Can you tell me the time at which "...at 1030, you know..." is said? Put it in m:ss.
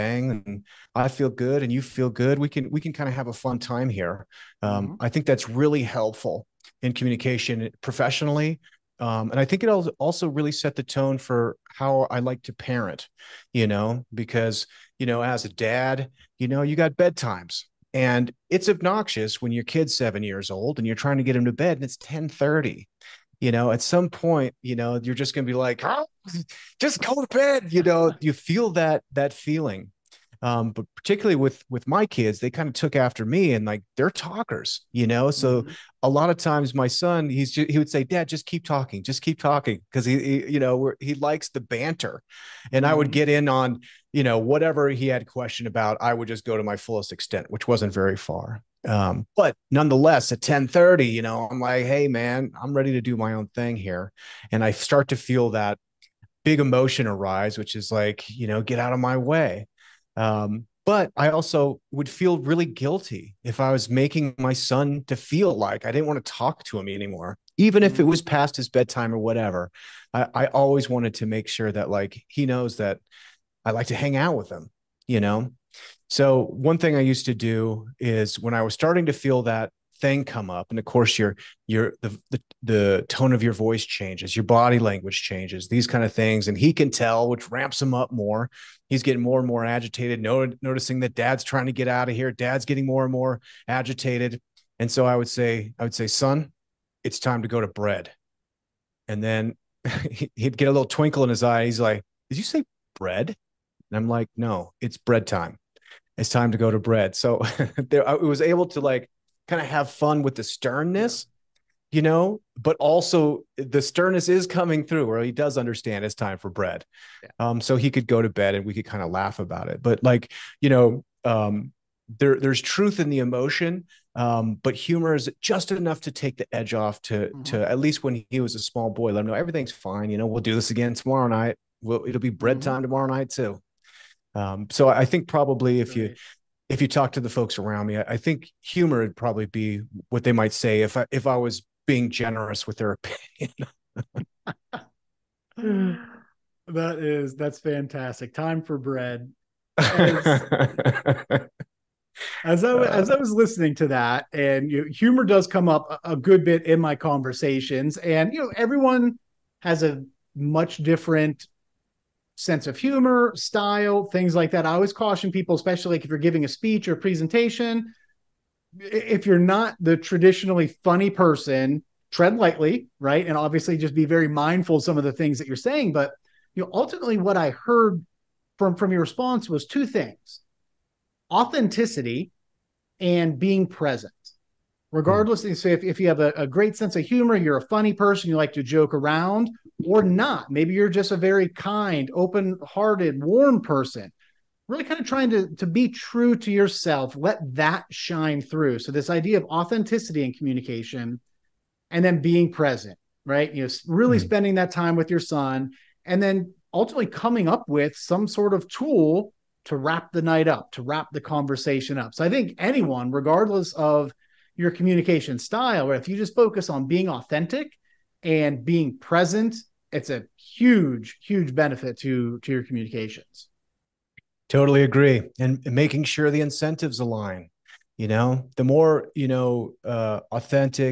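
0:50.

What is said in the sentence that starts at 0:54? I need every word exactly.
And I start to feel that big emotion arise, which is like, you know, get out of my way.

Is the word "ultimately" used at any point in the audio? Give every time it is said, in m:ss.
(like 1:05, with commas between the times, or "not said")
2:56, 3:26.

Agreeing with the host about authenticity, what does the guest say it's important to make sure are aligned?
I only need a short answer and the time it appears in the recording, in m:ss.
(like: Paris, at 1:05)
incentives, at 3:46.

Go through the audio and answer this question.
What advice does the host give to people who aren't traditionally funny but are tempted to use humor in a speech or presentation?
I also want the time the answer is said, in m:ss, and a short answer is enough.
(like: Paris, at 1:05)
tread lightly, at 2:52.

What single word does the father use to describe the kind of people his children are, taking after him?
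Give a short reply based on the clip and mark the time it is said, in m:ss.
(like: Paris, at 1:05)
talkers, at 0:34.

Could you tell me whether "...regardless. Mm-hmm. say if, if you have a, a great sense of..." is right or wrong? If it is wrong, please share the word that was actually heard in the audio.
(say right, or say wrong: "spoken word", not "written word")
right.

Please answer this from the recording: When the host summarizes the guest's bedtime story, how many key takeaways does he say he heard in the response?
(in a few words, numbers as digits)
2.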